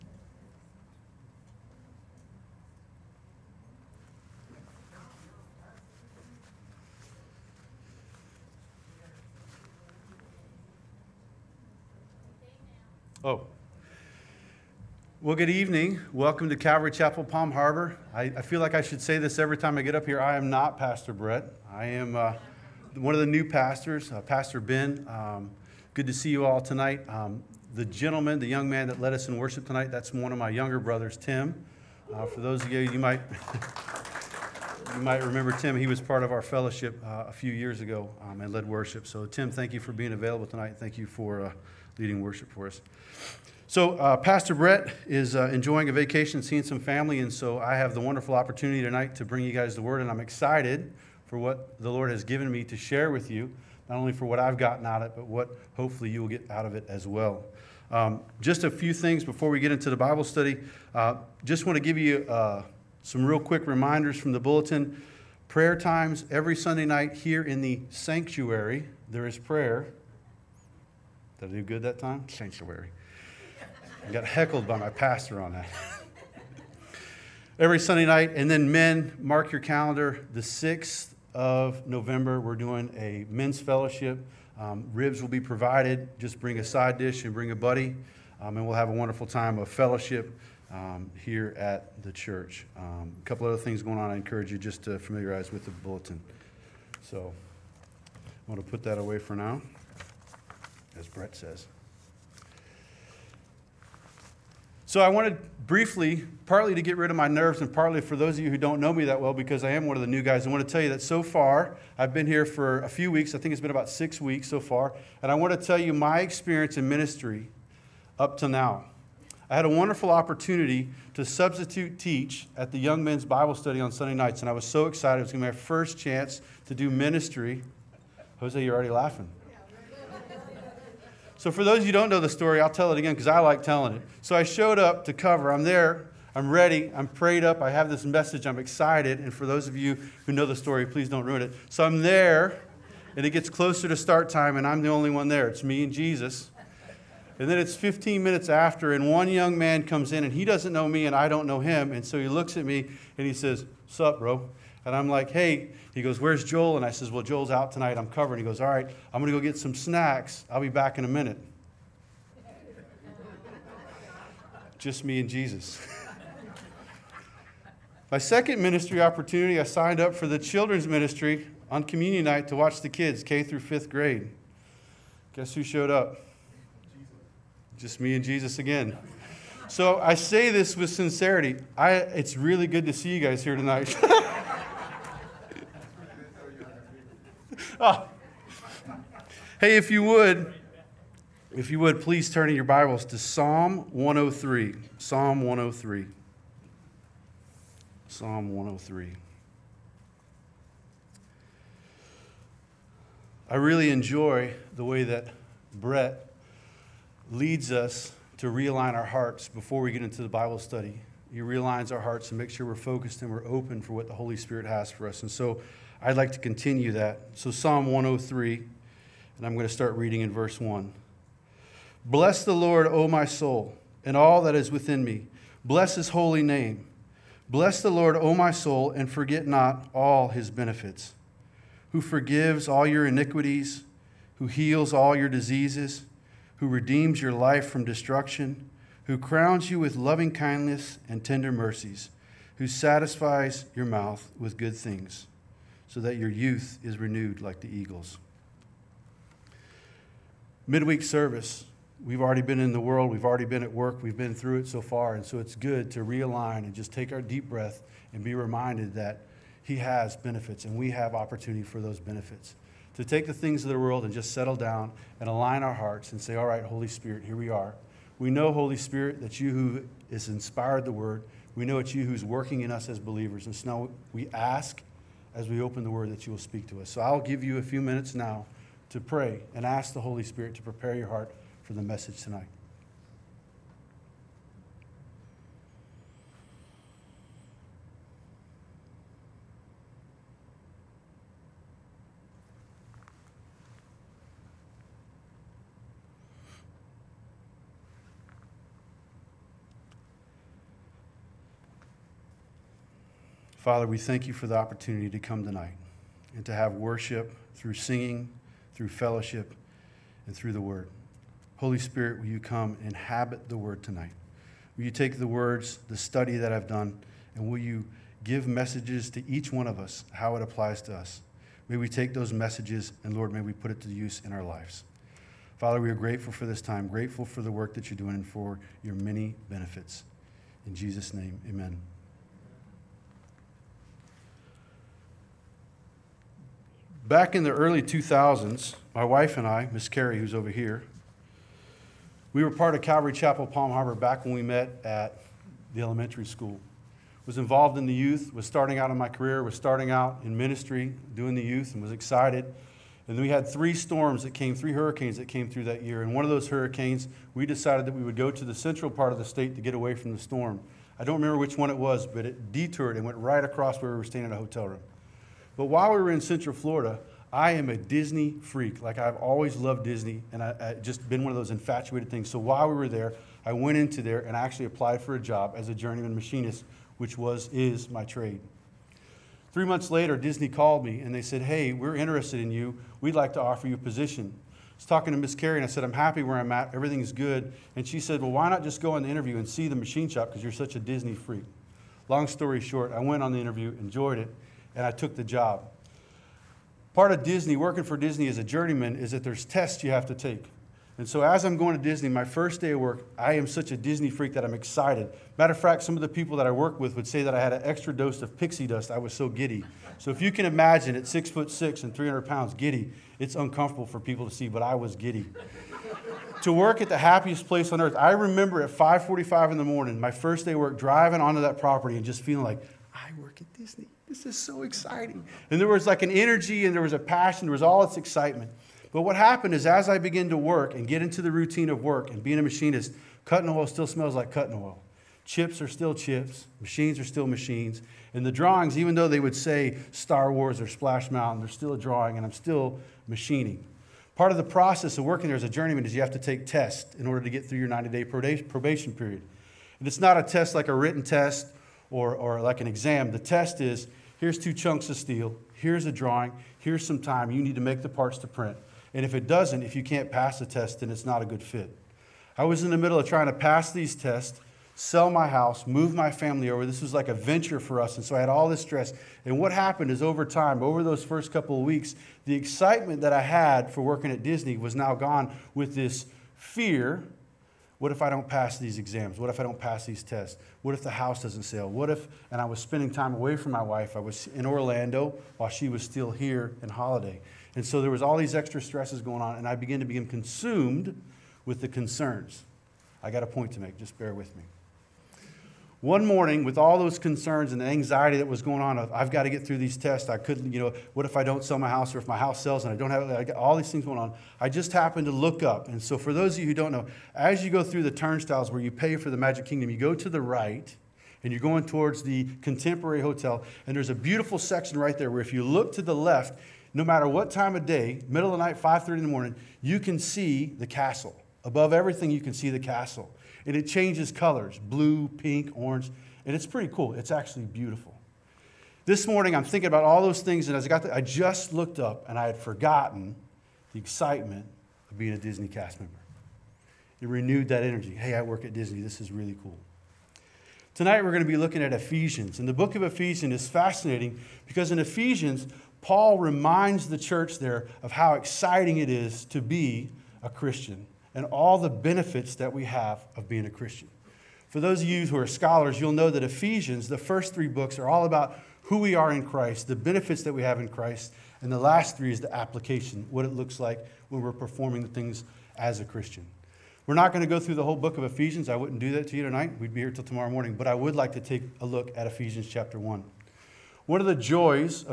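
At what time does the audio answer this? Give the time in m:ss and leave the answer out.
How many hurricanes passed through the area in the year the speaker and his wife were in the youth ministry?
5:54.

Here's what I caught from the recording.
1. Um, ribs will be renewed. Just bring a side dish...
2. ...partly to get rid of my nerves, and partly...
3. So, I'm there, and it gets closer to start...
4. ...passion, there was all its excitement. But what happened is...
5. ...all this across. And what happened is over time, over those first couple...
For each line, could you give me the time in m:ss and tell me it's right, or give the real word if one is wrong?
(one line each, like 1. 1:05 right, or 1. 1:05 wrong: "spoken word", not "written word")
1. 1:24 wrong: "provided", not "renewed"
2. 1:46 right
3. 2:21 right
4. 7:06 right
5. 7:48 wrong: "stress", not "across".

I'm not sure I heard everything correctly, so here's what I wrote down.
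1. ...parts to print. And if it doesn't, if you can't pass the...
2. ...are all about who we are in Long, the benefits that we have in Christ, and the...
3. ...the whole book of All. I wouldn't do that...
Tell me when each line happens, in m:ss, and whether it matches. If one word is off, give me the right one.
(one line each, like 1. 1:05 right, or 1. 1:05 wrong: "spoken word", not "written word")
1. 7:37 right
2. 9:17 wrong: "Christ", not "Long"
3. 9:27 wrong: "Ephesians", not "All".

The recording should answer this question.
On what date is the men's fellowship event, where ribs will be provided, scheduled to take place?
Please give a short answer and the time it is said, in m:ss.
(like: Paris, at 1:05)
6th of November, at 1:20.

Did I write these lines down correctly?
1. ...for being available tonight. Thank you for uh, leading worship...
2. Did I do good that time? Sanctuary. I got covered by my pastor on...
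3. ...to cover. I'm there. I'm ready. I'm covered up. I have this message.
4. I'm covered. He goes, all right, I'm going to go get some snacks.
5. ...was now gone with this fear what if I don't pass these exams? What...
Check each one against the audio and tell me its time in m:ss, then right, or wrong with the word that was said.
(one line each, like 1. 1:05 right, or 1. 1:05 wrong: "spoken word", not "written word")
1. 0:39 right
2. 1:11 wrong: "heckled", not "covered"
3. 2:15 wrong: "prayed", not "covered"
4. 2:37 right
5. 7:54 right.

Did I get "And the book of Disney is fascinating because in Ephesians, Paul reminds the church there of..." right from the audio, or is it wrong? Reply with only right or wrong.
wrong.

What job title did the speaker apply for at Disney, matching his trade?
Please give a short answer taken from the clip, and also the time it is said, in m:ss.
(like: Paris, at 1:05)
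journeyman machinist, at 6:15.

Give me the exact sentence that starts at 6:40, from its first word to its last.
And so, as I'm going to Disney, my first day of work, I am such a Disney freak that I'm excited.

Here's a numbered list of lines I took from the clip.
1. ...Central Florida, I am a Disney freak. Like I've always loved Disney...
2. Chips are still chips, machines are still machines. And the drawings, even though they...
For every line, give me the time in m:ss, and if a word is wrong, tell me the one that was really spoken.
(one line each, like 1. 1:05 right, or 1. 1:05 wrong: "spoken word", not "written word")
1. 6:06 right
2. 7:15 right.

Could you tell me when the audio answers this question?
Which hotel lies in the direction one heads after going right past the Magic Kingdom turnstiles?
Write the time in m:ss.
8:32.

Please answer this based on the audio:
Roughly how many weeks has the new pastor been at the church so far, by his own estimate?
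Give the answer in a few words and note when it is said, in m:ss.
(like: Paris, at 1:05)
6, at 1:53.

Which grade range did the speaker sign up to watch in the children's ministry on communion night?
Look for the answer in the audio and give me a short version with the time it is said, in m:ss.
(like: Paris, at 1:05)
K through fifth grade, at 2:53.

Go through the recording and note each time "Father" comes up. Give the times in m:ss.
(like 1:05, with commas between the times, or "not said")
5:03, 5:25.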